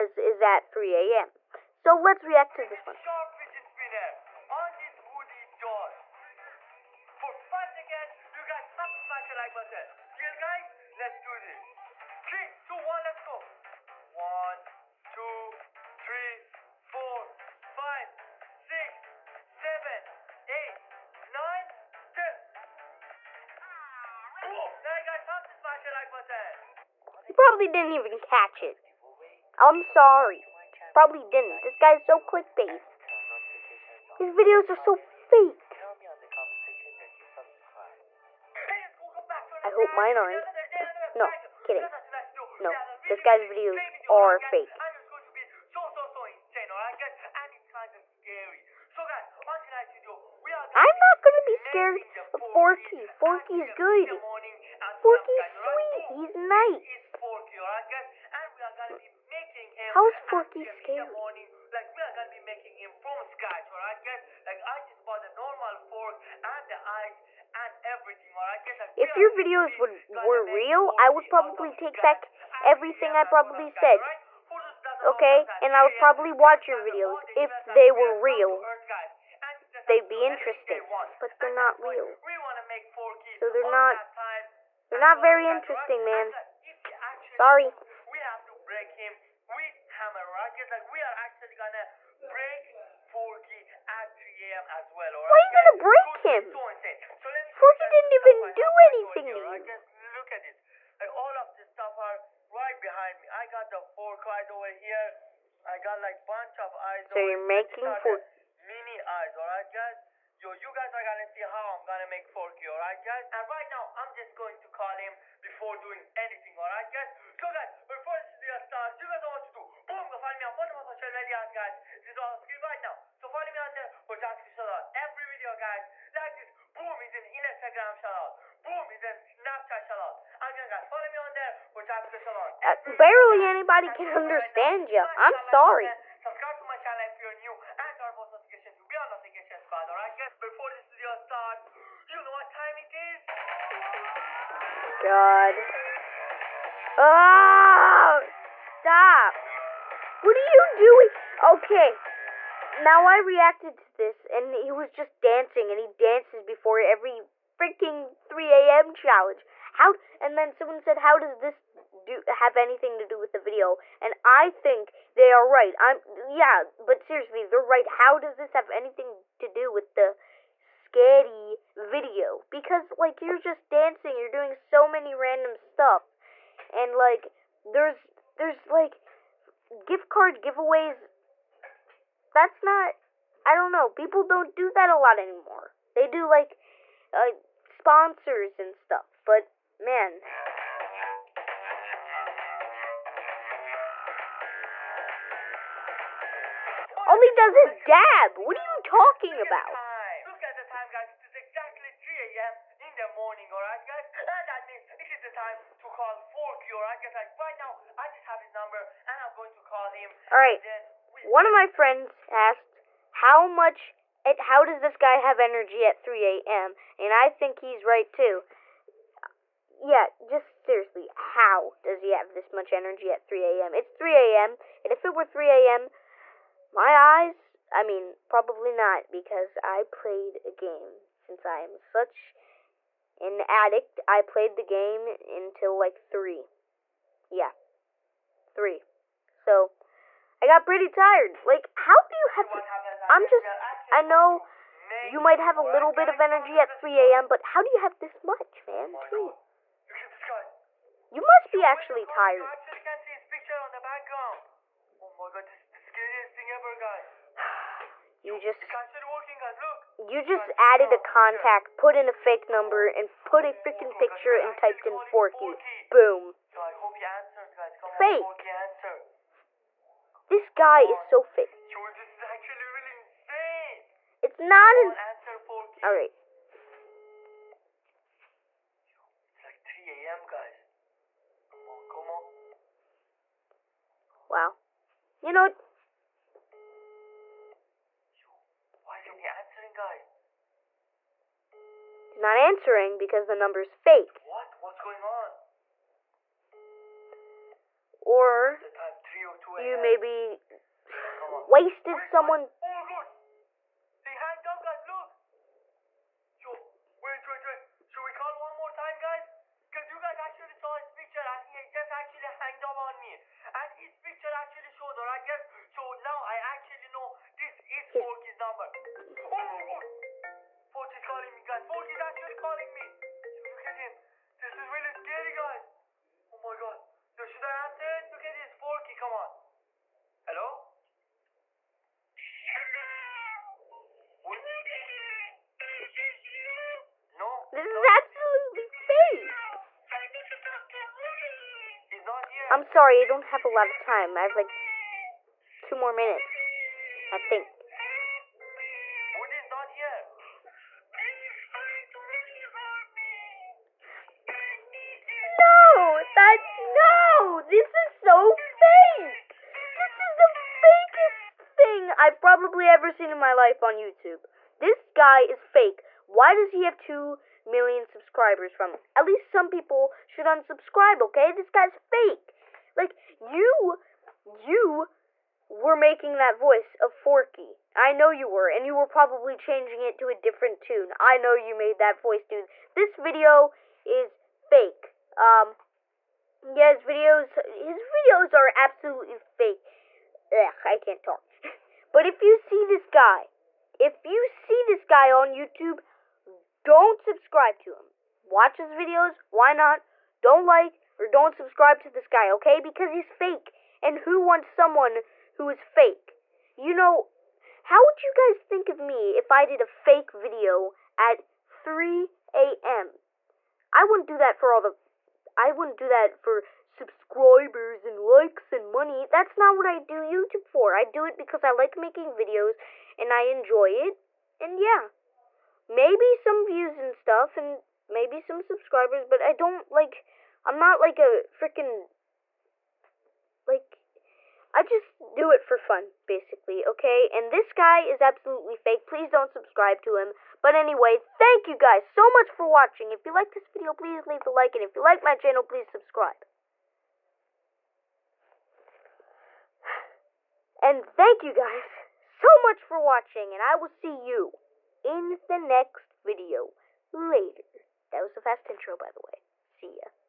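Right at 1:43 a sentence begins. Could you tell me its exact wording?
I got the fork right over here.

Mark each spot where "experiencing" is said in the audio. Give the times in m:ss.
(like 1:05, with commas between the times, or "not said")
not said.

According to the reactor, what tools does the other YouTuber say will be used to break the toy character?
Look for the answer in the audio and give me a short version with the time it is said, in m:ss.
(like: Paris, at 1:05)
Hammer rockets, at 1:29.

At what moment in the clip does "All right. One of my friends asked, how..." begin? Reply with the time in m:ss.
3:30.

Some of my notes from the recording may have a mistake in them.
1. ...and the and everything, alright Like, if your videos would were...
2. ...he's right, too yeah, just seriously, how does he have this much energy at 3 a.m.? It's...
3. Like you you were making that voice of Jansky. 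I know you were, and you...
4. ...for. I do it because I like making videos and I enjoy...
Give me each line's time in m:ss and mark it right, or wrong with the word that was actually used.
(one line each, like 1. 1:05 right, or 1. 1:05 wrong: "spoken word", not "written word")
1. 1:06 right
2. 3:37 right
3. 6:12 wrong: "Forky", not "Jansky"
4. 7:00 right.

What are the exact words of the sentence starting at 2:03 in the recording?
So follow me on there for Jansky shout out every video, guys.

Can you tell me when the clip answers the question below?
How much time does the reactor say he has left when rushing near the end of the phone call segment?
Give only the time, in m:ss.
5:45.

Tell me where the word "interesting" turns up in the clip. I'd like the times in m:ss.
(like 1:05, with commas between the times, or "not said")
1:20, 1:25.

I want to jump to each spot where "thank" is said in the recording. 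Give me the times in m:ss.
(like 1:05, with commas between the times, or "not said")
7:20, 7:30.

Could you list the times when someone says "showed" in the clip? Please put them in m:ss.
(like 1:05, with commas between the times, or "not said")
5:14.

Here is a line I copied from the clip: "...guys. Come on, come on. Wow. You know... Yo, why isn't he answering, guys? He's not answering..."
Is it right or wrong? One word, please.
right.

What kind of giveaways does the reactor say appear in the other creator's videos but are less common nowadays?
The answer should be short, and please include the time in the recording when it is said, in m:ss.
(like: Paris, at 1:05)
Gift card giveaways, at 2:59.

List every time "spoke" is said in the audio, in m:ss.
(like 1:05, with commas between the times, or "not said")
not said.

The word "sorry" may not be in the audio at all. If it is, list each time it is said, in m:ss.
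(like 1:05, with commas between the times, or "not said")
0:29, 1:27, 2:15, 5:42.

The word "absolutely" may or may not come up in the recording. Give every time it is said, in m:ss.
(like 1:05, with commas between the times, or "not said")
5:38, 6:28, 7:17.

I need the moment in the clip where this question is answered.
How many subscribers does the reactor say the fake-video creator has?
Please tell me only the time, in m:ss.
6:06.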